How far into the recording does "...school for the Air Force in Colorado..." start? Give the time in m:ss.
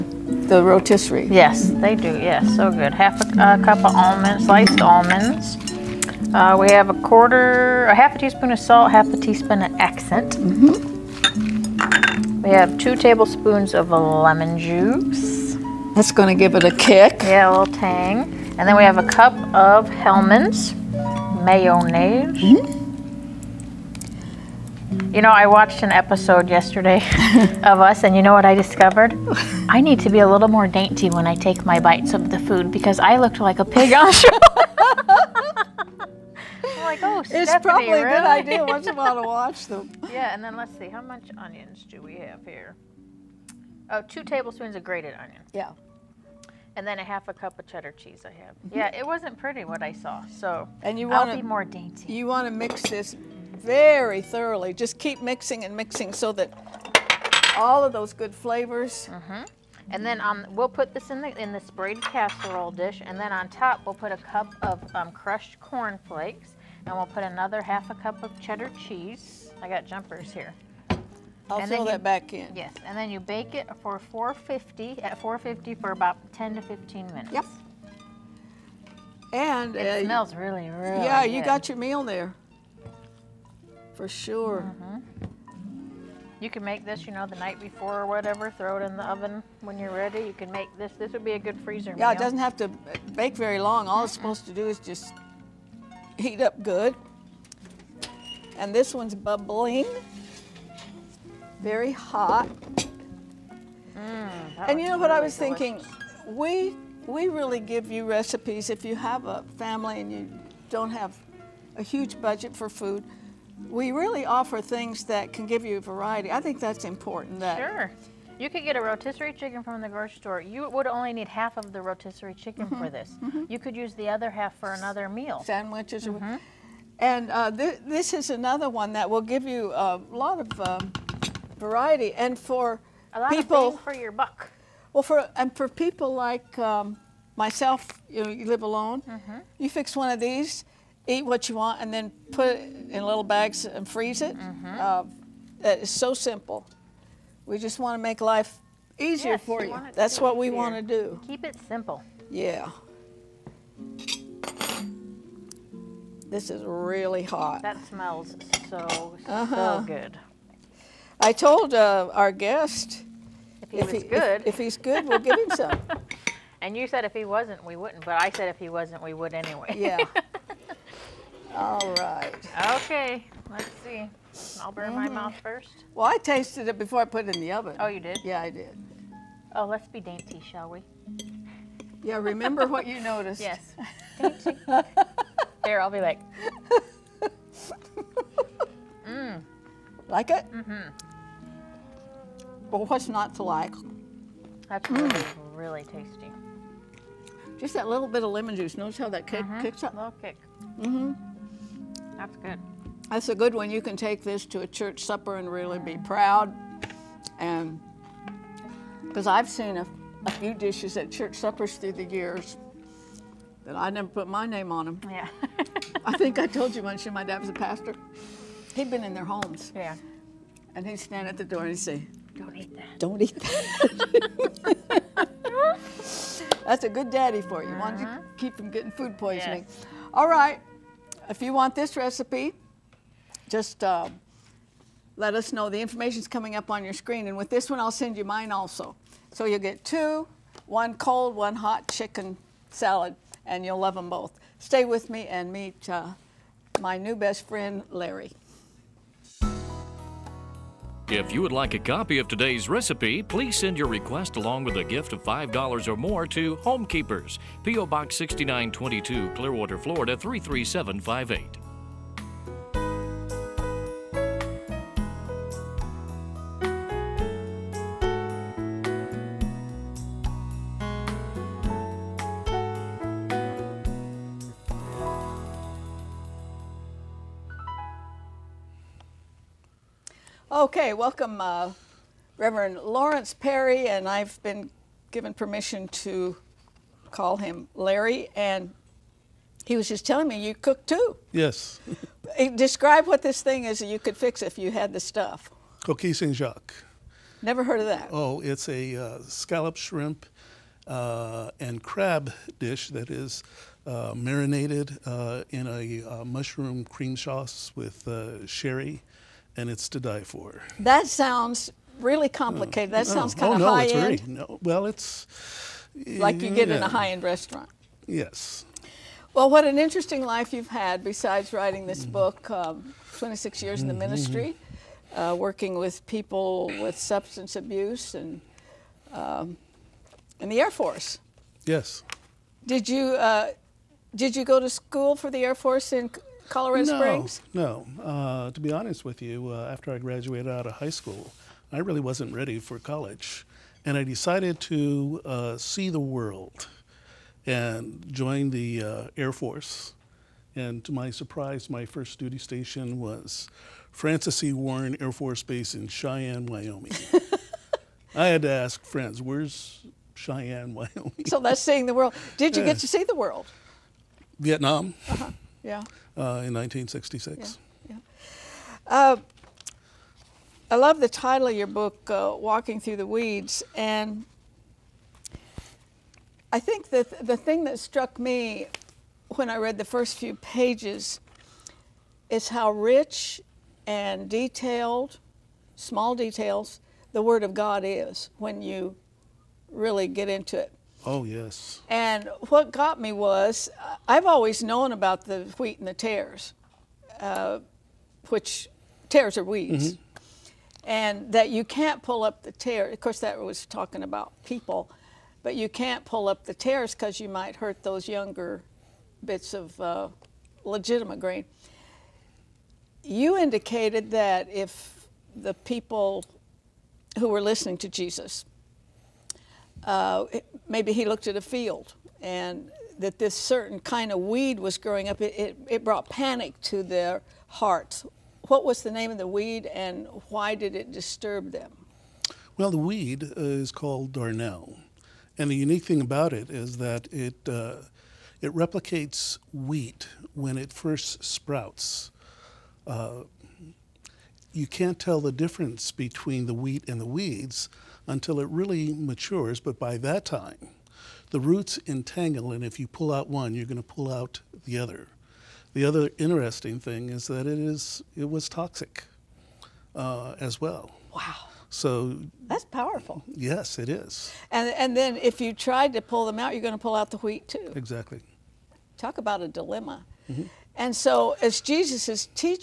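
5:34.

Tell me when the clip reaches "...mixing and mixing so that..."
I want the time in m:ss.
0:55.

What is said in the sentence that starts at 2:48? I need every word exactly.
But I said if he wasn't, we would anyway.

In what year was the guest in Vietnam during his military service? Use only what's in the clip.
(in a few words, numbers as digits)
1966.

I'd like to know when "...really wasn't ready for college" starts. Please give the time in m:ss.
5:41.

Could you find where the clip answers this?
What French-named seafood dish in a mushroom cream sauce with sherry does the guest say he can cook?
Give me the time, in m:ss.
4:55.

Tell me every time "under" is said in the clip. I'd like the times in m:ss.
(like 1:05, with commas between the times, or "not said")
not said.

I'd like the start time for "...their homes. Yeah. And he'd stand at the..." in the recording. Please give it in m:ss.
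3:39.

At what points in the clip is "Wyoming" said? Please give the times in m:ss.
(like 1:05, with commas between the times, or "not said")
5:56, 6:00.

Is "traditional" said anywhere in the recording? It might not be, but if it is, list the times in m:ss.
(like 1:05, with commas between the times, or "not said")
not said.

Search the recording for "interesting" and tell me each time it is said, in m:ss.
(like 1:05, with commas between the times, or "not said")
5:19, 7:36.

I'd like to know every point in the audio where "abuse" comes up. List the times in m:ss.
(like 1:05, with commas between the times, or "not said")
5:27.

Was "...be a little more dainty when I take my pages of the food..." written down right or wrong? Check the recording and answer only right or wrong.
wrong.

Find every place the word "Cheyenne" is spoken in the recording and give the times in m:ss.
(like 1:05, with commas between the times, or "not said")
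5:55, 6:00.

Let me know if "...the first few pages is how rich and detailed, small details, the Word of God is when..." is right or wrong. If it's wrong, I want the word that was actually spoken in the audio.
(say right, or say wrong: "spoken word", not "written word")
right.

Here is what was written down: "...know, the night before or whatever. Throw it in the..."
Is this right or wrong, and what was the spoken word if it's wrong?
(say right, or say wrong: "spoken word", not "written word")
right.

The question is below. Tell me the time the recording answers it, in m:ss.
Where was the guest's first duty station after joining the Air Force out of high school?
5:53.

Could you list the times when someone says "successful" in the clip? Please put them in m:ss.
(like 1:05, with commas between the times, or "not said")
not said.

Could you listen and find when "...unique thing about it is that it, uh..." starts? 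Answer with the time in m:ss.
7:15.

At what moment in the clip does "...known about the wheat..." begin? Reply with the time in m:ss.
6:34.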